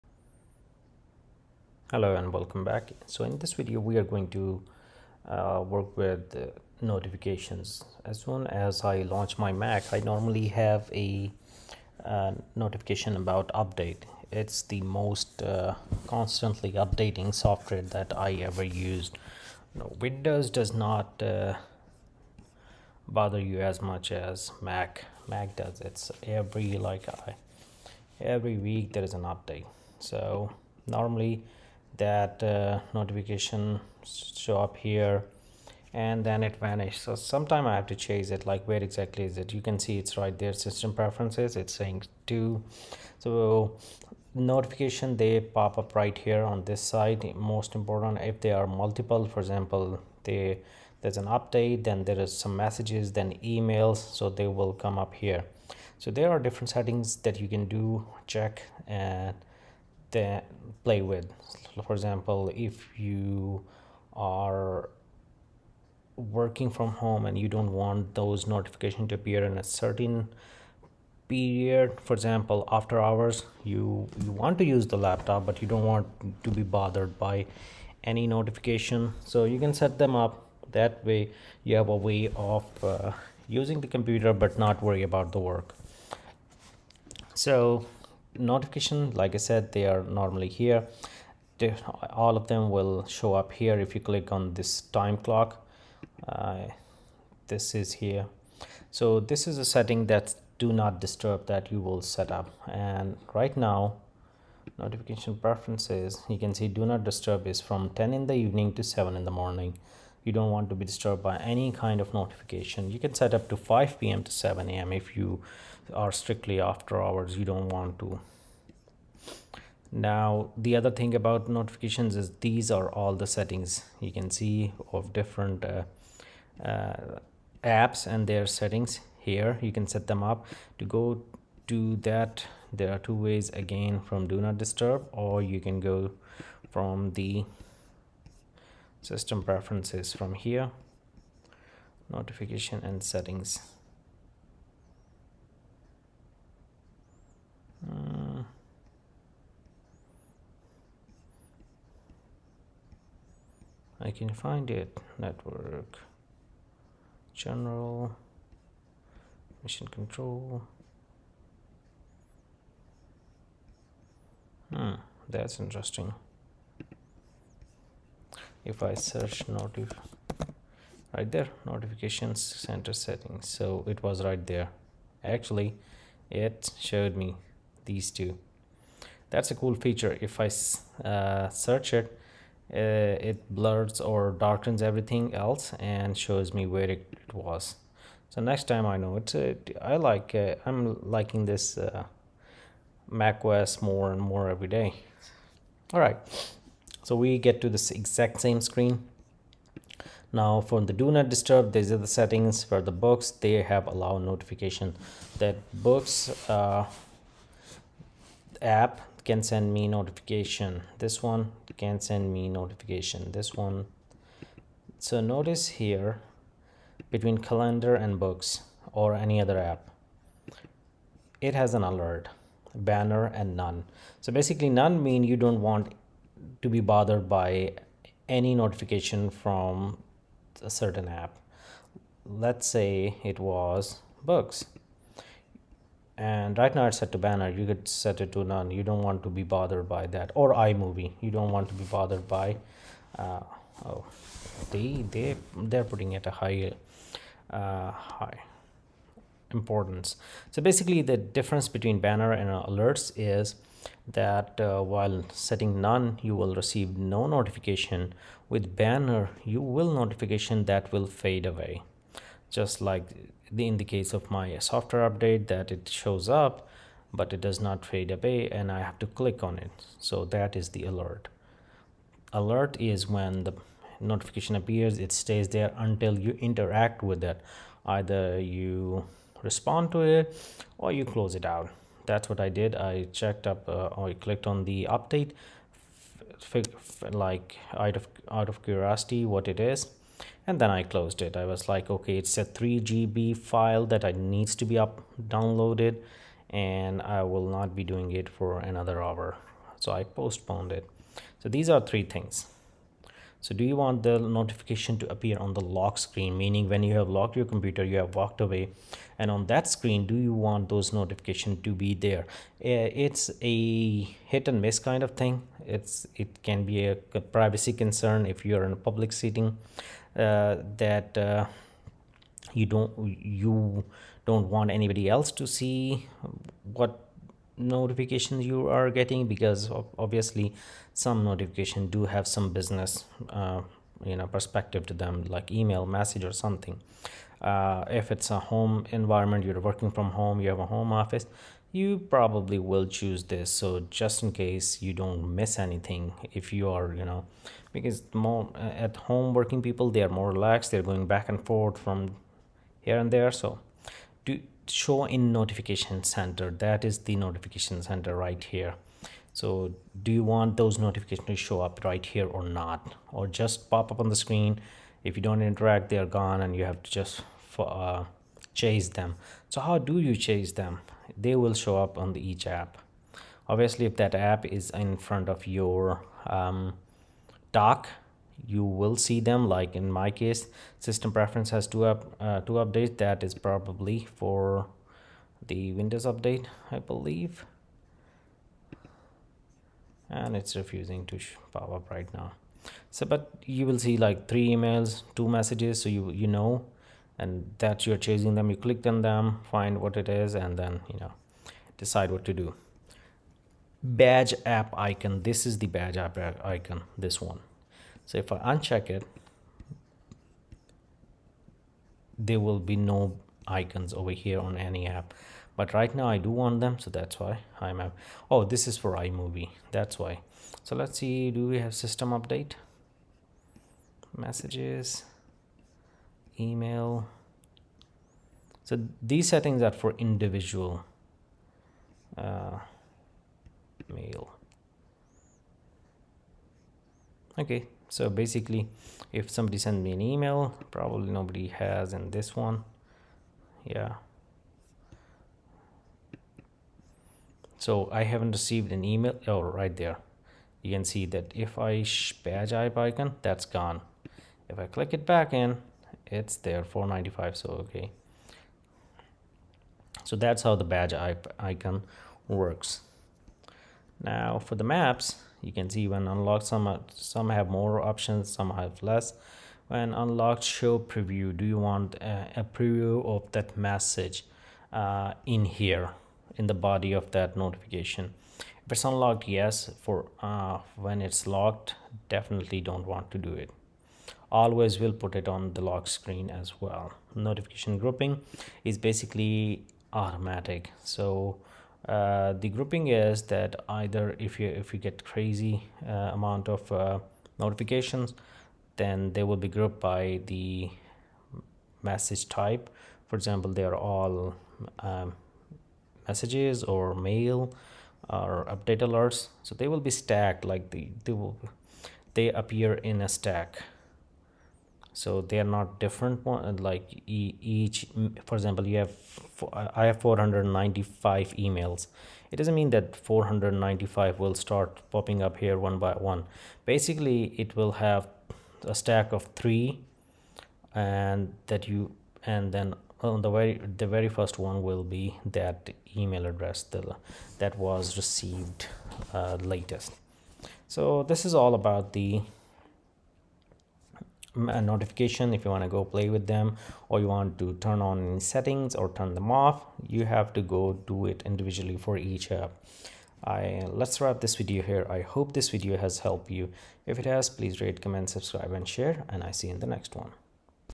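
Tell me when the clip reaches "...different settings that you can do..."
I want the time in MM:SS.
00:56.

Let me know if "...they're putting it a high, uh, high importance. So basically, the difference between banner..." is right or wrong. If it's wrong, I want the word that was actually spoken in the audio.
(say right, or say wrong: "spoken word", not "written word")
right.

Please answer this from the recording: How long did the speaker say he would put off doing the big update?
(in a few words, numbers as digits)
another hour.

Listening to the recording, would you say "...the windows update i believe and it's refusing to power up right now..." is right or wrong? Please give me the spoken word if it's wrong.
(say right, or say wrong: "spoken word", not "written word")
right.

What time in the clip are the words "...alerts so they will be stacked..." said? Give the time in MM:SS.
08:28.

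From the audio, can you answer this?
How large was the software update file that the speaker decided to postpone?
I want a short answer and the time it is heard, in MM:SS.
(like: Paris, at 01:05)
3 GB, at 04:52.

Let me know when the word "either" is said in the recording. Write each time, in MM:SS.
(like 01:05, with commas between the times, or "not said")
04:37, 08:13.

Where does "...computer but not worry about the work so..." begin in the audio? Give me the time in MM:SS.
01:23.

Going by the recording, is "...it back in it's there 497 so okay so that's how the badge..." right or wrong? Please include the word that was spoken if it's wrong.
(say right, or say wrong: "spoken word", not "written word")
wrong: "495", not "497".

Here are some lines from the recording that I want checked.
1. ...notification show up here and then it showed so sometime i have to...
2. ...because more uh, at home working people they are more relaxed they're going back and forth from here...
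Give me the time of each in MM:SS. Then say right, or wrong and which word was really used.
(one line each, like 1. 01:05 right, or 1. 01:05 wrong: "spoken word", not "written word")
1. 00:32 wrong: "vanished", not "showed"
2. 05:47 right.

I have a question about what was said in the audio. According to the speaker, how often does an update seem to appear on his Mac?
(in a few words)
every week.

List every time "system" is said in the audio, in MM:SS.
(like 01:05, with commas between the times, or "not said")
00:40, 02:19, 06:20, 07:01.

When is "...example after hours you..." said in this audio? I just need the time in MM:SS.
01:12.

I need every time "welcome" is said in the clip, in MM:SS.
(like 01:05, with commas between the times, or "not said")
00:02.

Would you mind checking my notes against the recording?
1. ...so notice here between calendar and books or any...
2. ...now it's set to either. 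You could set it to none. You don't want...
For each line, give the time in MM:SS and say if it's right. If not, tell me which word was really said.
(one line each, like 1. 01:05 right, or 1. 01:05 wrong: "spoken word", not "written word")
1. 03:34 right
2. 03:56 wrong: "banner", not "either".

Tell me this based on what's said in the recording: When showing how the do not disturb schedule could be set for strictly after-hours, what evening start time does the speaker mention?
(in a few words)
5 p.m.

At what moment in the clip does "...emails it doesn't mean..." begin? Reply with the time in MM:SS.
08:41.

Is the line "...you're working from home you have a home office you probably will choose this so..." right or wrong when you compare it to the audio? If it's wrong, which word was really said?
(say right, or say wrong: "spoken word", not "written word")
right.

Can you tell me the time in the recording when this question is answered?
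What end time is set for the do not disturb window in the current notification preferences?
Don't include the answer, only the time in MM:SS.
01:48.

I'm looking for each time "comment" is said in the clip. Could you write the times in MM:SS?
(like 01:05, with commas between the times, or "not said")
09:17.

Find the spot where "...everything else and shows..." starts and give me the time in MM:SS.
03:04.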